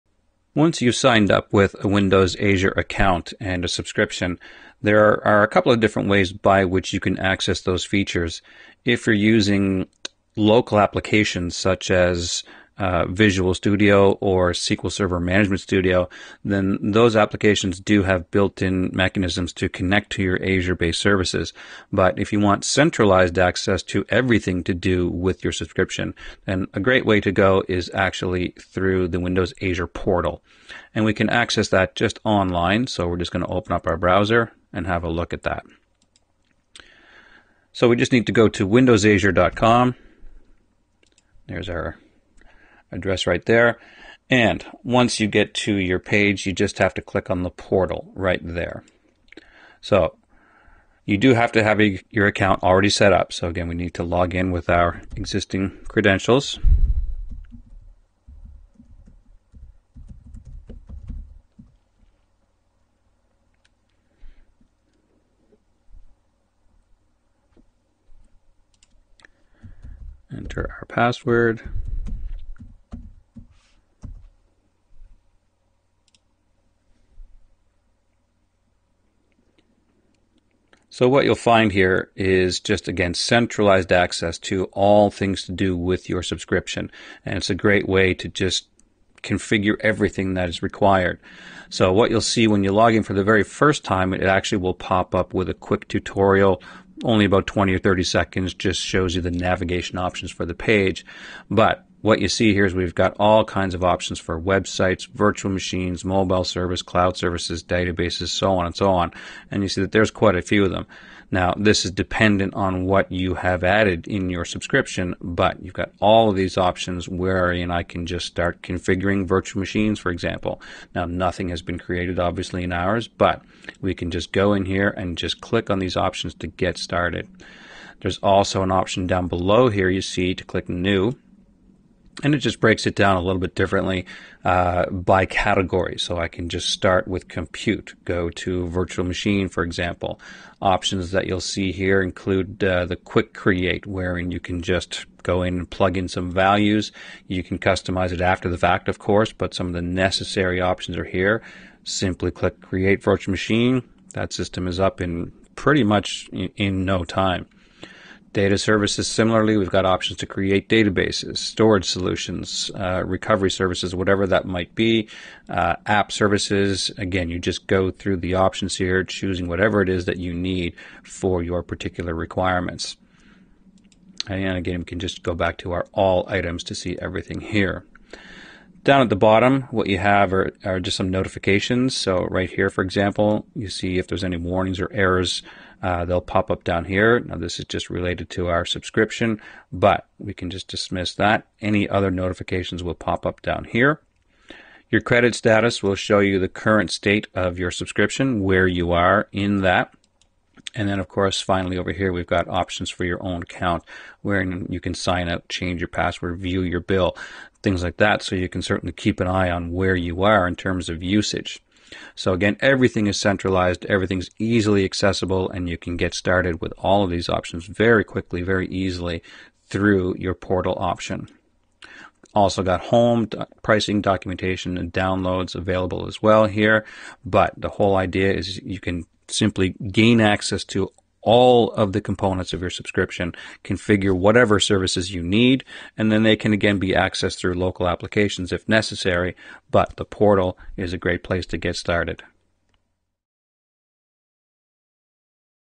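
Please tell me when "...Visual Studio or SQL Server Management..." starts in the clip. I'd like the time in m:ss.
0:13.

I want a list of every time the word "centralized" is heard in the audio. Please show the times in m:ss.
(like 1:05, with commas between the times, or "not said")
0:22, 1:23, 3:33.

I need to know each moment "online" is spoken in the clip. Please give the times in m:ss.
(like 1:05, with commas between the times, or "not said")
0:32.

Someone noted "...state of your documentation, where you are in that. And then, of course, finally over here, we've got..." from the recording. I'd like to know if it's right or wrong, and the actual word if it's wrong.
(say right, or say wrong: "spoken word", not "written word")
wrong: "subscription", not "documentation".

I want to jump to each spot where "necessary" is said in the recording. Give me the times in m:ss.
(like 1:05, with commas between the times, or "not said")
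2:29, 3:58.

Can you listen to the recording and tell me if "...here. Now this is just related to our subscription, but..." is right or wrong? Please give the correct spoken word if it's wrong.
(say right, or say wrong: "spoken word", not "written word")
right.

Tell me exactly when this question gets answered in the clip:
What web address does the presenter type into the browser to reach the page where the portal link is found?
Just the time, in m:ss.
0:38.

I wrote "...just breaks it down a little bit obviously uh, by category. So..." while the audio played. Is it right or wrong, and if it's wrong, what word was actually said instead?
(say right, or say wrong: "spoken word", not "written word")
wrong: "differently", not "obviously".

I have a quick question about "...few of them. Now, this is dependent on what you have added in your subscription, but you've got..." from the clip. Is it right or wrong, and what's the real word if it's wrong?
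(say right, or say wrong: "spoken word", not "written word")
right.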